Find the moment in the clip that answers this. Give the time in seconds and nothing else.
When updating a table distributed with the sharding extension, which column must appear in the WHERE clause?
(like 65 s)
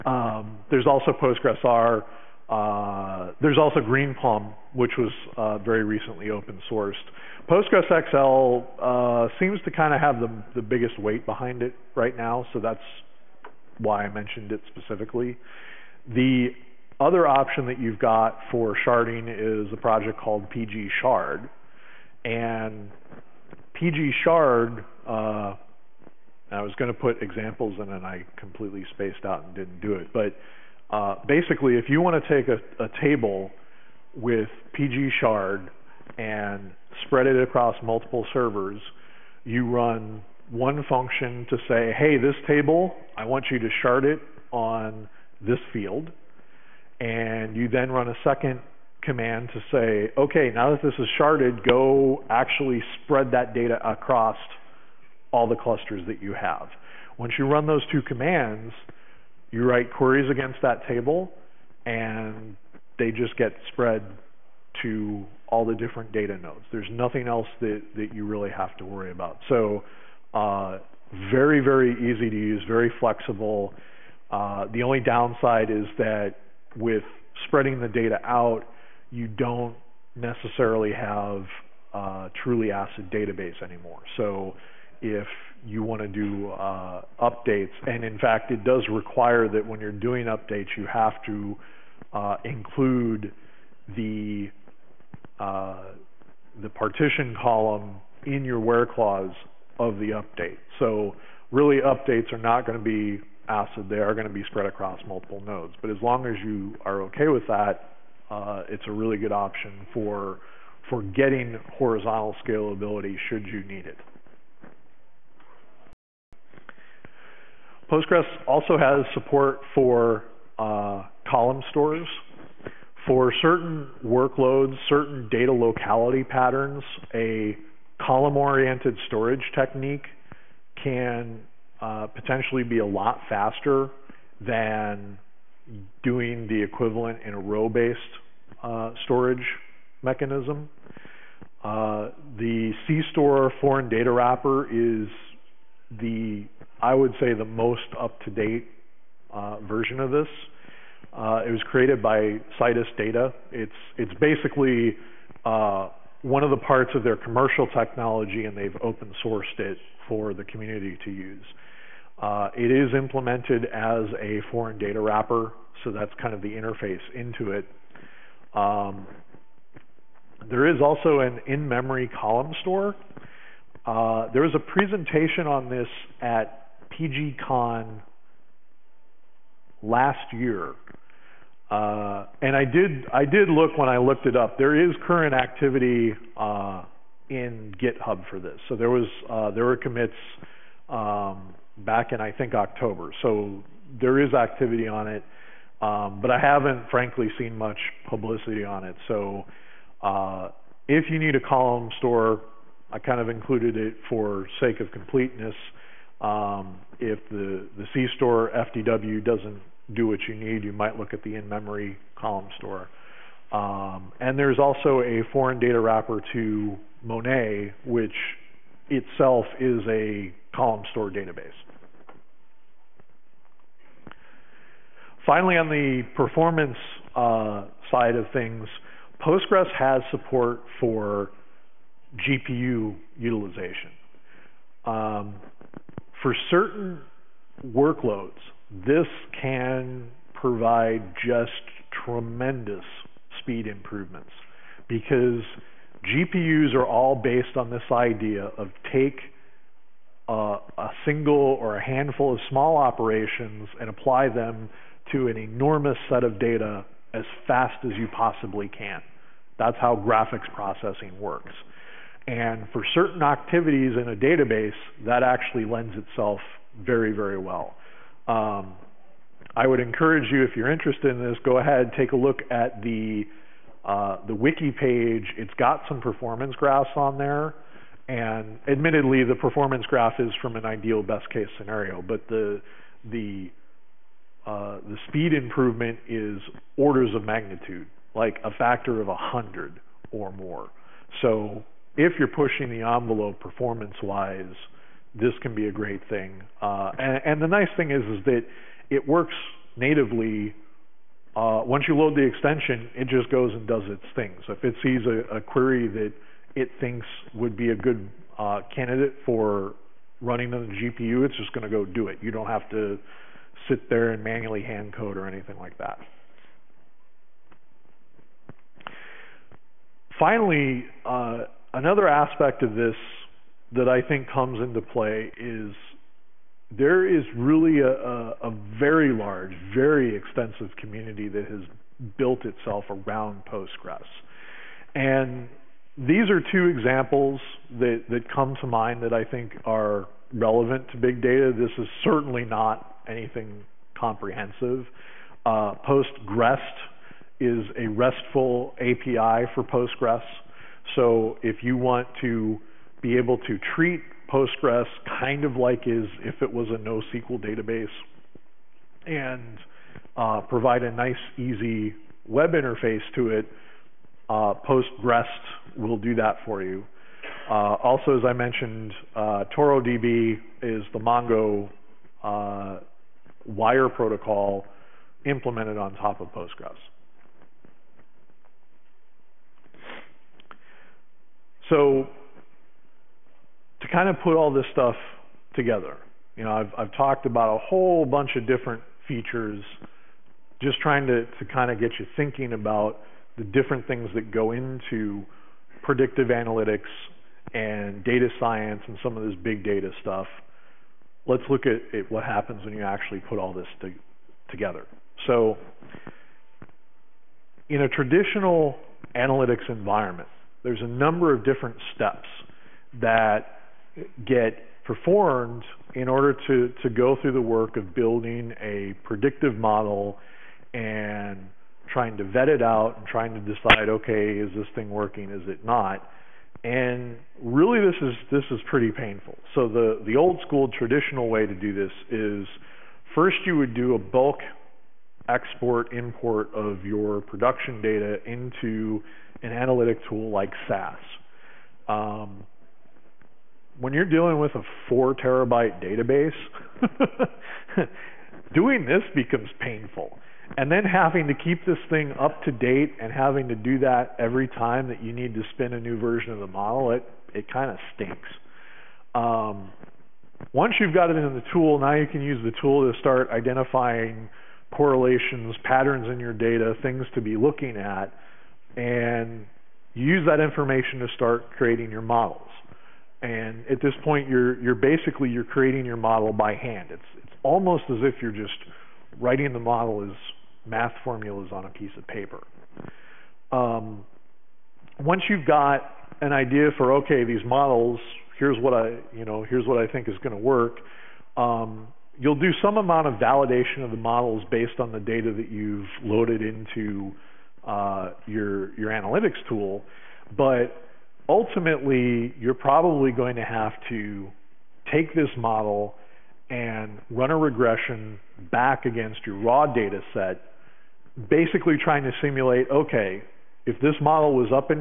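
96 s.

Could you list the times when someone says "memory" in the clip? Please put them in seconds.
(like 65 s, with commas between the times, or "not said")
171 s, 211 s.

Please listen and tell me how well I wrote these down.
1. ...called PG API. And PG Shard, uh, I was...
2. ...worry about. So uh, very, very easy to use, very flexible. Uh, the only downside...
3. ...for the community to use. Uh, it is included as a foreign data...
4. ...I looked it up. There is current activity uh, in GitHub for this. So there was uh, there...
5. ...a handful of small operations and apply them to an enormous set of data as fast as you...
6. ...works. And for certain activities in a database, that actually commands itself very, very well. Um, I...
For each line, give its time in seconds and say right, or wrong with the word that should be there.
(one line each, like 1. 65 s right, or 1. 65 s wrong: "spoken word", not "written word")
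1. 20 s wrong: "Shard", not "API"
2. 68 s right
3. 160 s wrong: "implemented", not "included"
4. 183 s right
5. 251 s right
6. 261 s wrong: "lends", not "commands".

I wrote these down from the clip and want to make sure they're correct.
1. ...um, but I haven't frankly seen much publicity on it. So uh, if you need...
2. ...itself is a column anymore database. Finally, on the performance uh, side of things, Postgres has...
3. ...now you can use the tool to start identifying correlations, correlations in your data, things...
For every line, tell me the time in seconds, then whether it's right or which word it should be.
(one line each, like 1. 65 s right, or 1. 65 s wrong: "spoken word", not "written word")
1. 195 s right
2. 218 s wrong: "store", not "anymore"
3. 461 s wrong: "patterns", not "correlations".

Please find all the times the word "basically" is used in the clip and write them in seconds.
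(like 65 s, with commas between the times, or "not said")
31 s, 154 s, 474 s, 511 s.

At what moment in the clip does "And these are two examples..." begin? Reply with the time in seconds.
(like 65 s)
334 s.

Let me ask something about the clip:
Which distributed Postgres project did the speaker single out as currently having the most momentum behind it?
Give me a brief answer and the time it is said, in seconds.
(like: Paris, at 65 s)
Postgres XL, at 7 s.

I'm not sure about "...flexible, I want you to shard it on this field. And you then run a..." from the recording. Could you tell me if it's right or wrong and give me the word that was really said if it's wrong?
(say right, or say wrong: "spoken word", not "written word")
wrong: "table", not "flexible".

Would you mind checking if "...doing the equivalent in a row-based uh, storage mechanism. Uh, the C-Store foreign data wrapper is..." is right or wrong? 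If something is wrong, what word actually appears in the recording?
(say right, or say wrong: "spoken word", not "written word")
right.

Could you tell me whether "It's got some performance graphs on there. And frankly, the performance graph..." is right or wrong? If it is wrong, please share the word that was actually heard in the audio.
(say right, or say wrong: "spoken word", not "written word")
wrong: "admittedly", not "frankly".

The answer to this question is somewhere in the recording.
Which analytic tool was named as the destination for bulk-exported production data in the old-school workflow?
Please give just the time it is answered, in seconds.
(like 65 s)
440 s.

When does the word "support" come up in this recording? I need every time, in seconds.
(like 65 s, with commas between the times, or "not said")
119 s, 230 s.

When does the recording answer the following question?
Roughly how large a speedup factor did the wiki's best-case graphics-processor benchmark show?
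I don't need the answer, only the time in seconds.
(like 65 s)
289 s.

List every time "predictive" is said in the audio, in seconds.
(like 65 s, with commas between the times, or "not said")
395 s, 419 s.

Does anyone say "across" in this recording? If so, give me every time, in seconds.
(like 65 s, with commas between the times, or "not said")
37 s, 53 s, 104 s.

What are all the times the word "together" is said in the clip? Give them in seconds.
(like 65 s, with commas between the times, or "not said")
385 s, 404 s.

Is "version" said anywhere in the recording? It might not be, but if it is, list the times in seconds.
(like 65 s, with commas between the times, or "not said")
149 s, 455 s.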